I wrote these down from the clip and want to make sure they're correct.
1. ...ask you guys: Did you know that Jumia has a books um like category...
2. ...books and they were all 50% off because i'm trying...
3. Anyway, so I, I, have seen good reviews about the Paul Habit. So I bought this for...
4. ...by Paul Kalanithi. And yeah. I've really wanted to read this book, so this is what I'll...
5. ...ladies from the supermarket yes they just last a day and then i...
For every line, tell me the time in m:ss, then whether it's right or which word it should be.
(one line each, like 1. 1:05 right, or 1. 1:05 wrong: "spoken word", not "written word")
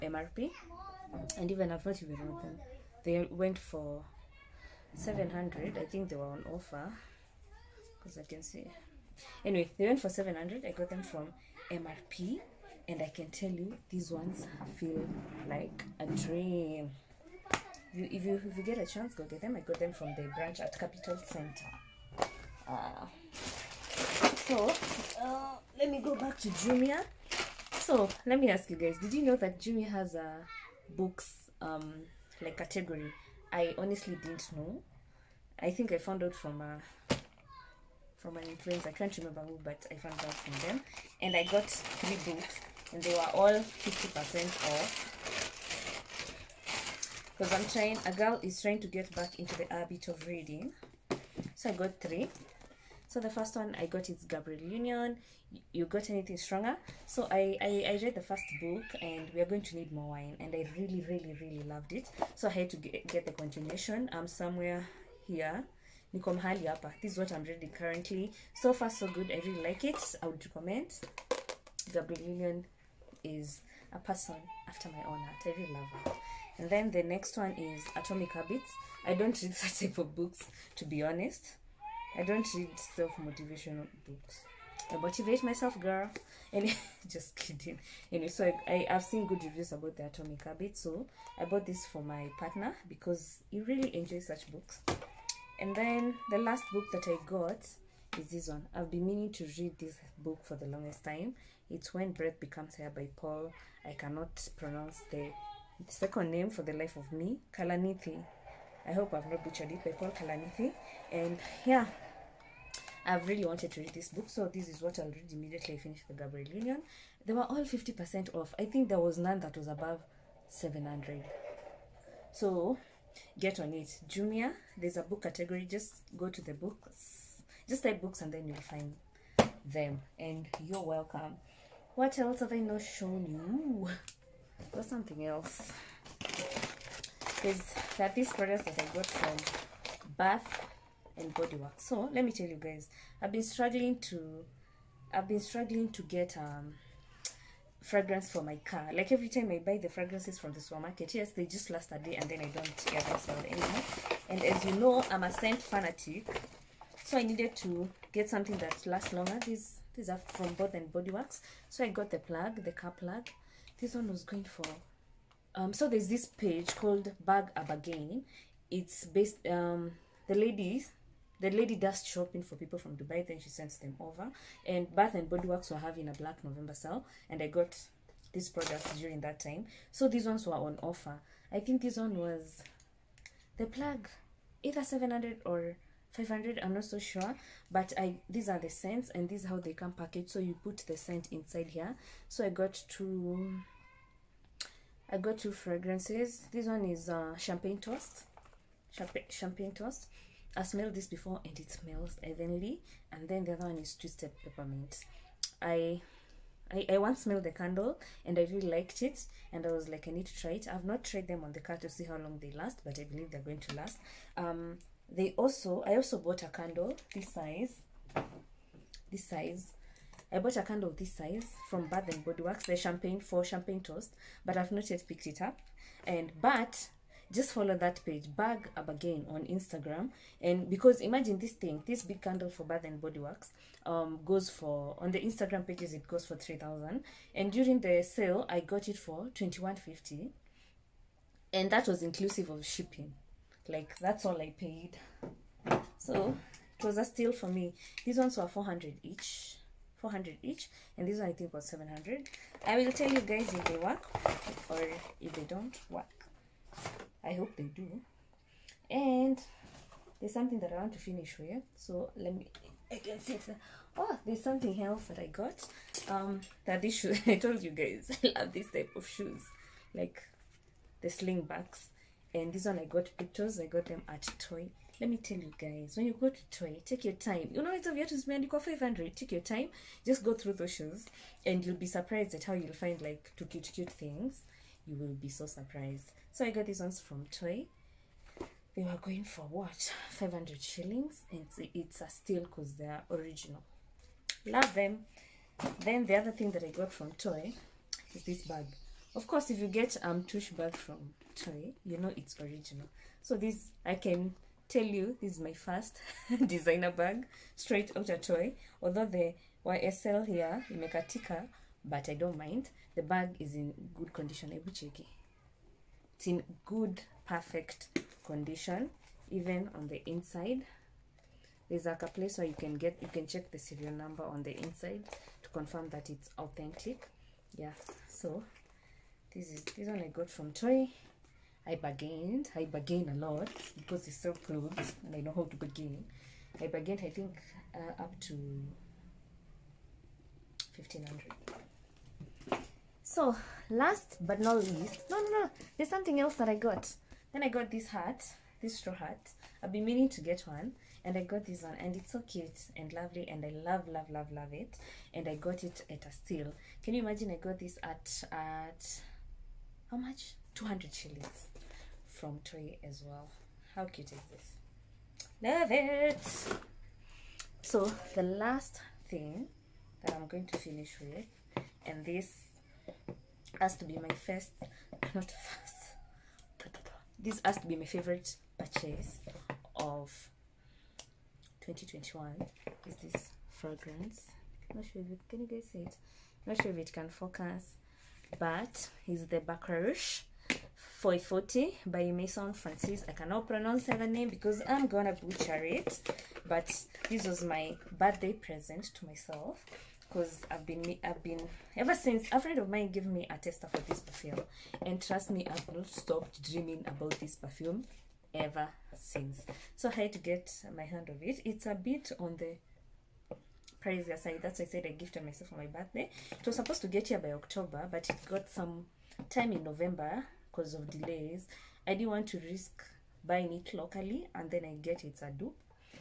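1. 0:28 right
2. 0:42 right
3. 1:28 wrong: "Atomic", not "Paul"
4. 1:49 right
5. 2:29 wrong: "fragrances", not "ladies".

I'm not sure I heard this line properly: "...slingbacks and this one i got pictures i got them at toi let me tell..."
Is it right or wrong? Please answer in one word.
right.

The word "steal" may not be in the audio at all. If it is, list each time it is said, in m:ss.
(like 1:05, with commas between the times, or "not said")
4:07, 4:52, 5:56.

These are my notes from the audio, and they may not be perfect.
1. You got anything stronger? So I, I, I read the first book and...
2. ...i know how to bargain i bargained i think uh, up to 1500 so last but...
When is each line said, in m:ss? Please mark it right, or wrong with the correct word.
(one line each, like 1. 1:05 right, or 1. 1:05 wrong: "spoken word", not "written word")
1. 0:55 right
2. 5:35 right.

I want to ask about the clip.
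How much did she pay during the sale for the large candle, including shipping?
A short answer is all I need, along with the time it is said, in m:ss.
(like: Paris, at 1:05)
2150, at 3:59.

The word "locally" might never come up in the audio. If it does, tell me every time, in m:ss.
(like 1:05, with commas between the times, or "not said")
7:03.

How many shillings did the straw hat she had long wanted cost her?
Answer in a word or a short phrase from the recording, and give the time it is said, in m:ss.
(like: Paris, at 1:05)
200, at 6:00.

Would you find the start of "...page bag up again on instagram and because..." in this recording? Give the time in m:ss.
3:48.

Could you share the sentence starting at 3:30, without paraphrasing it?
I've not tried them on the car to see how long they last, but I believe they're going to last.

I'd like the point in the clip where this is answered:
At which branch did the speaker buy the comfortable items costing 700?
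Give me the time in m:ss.
0:20.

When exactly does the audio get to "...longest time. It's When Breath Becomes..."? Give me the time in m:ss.
1:40.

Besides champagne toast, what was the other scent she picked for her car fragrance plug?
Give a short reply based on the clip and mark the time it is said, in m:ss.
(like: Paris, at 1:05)
twisted peppermint, at 3:23.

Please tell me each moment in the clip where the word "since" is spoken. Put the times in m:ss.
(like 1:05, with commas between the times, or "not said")
6:41, 6:48.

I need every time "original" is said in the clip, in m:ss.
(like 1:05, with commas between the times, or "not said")
4:53, 5:02.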